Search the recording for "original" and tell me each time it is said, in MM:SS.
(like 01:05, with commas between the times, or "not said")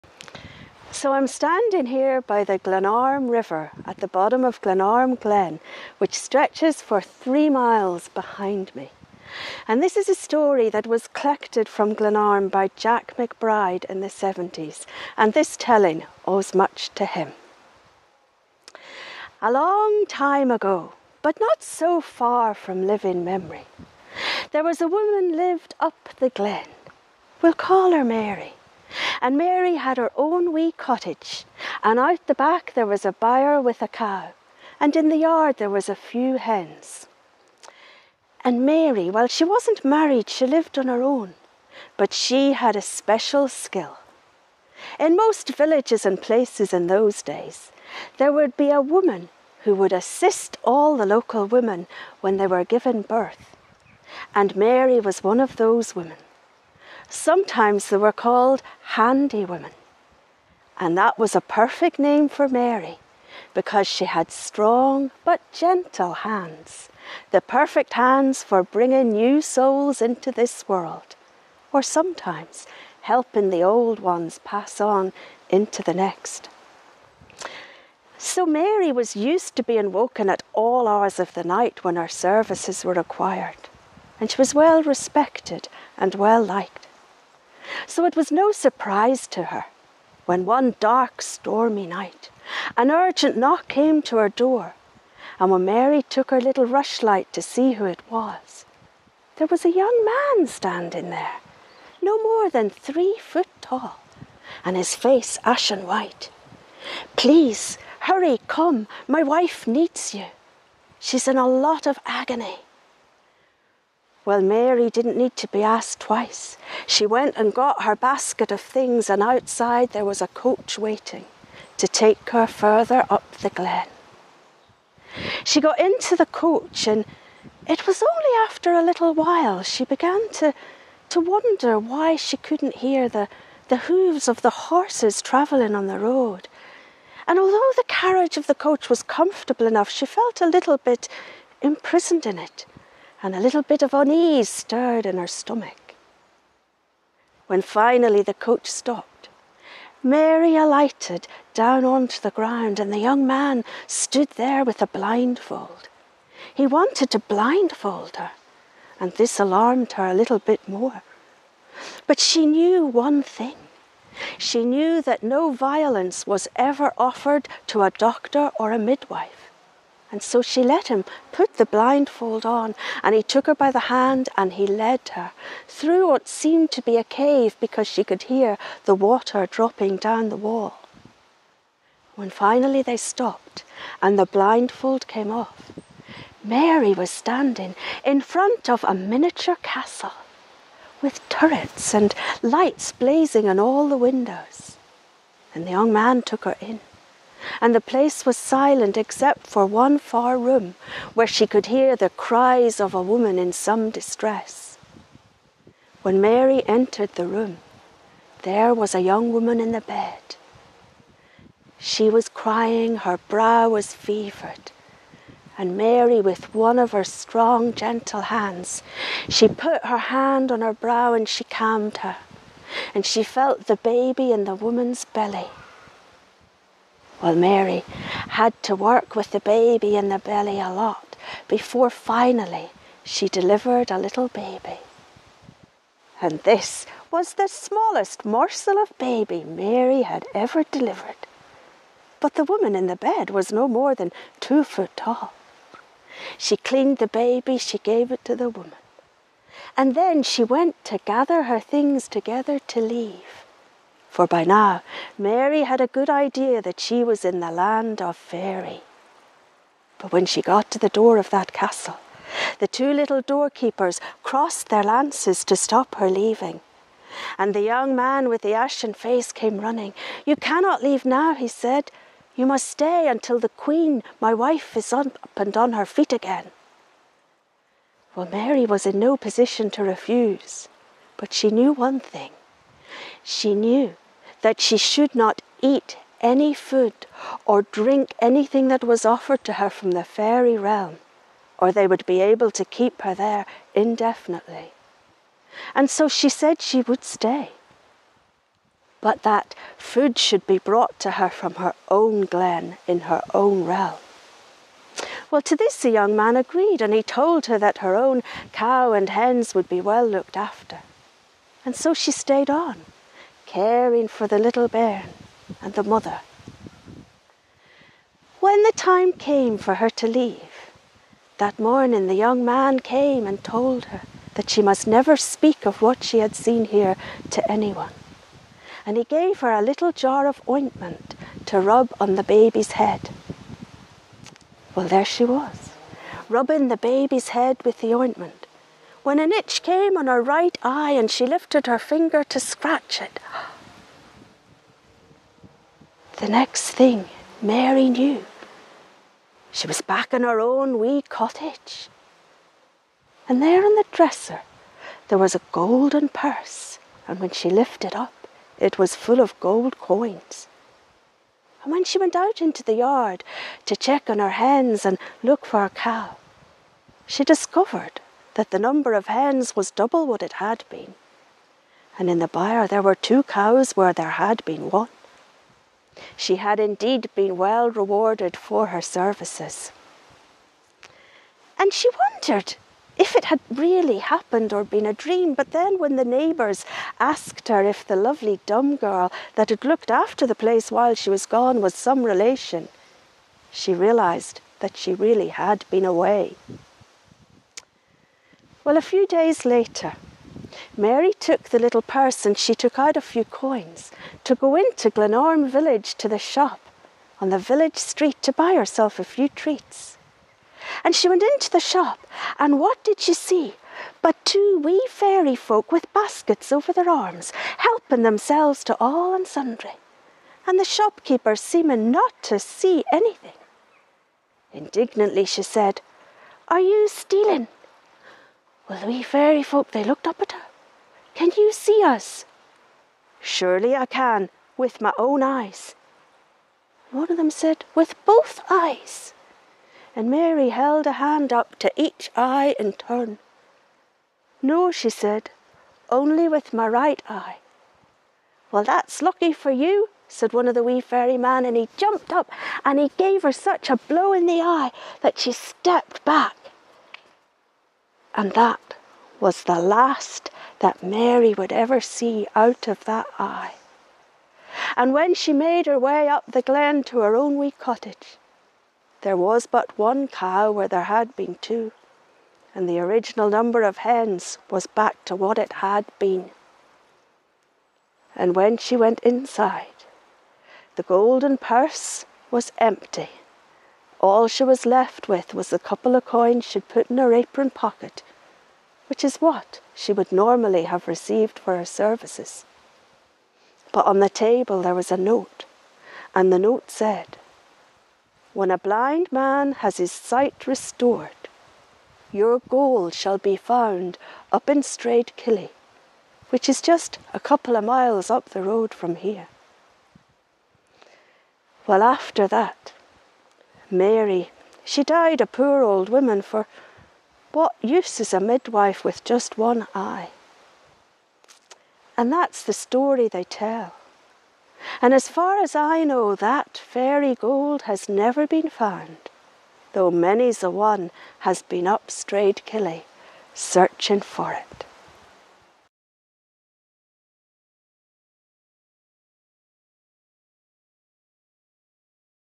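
07:52.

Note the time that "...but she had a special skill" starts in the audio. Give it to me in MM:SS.
00:41.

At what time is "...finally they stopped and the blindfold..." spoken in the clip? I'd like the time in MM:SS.
03:02.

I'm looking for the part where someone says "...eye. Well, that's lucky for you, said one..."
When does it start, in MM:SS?
07:27.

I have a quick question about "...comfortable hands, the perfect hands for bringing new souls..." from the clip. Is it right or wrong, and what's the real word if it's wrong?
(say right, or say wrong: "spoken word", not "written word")
wrong: "gentle", not "comfortable".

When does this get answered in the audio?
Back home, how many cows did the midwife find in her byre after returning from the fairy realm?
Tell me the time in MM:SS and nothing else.
06:12.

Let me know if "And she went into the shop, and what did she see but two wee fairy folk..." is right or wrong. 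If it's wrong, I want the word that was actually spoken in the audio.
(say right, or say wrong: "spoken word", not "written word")
right.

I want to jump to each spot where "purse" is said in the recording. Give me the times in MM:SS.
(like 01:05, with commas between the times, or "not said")
05:56, 06:41, 08:01.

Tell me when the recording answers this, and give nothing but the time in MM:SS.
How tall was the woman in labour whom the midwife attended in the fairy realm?
04:04.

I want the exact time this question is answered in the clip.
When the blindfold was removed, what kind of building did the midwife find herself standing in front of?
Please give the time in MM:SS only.
03:08.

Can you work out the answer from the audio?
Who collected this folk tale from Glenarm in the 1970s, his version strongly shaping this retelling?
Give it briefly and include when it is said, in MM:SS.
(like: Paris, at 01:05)
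Jack McBride, at 00:12.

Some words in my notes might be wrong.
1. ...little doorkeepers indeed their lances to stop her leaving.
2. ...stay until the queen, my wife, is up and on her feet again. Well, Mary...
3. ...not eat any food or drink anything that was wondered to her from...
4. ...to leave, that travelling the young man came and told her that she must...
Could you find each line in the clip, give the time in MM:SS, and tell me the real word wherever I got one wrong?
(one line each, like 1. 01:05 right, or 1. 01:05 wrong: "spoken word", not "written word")
1. 04:22 wrong: "crossed", not "indeed"
2. 04:32 right
3. 04:45 wrong: "offered", not "wondered"
4. 05:19 wrong: "morning", not "travelling".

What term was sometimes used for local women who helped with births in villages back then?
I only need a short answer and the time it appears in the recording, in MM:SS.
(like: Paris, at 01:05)
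handy women, at 00:58.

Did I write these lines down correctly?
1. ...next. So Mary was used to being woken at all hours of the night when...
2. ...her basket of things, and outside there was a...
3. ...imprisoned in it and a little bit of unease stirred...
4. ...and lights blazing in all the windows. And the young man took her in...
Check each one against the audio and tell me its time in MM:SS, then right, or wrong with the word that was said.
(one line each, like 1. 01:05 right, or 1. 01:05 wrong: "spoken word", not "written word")
1. 01:15 right
2. 01:57 right
3. 02:21 right
4. 03:11 right.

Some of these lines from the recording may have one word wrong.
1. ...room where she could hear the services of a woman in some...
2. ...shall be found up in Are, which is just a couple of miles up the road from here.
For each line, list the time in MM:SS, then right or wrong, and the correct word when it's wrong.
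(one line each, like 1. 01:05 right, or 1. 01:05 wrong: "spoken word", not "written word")
1. 03:20 wrong: "cries", not "services"
2. 08:22 wrong: "Straidkilly", not "Are".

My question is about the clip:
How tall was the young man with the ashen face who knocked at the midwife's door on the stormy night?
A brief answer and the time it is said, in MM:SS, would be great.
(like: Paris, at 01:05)
3 feet, at 01:42.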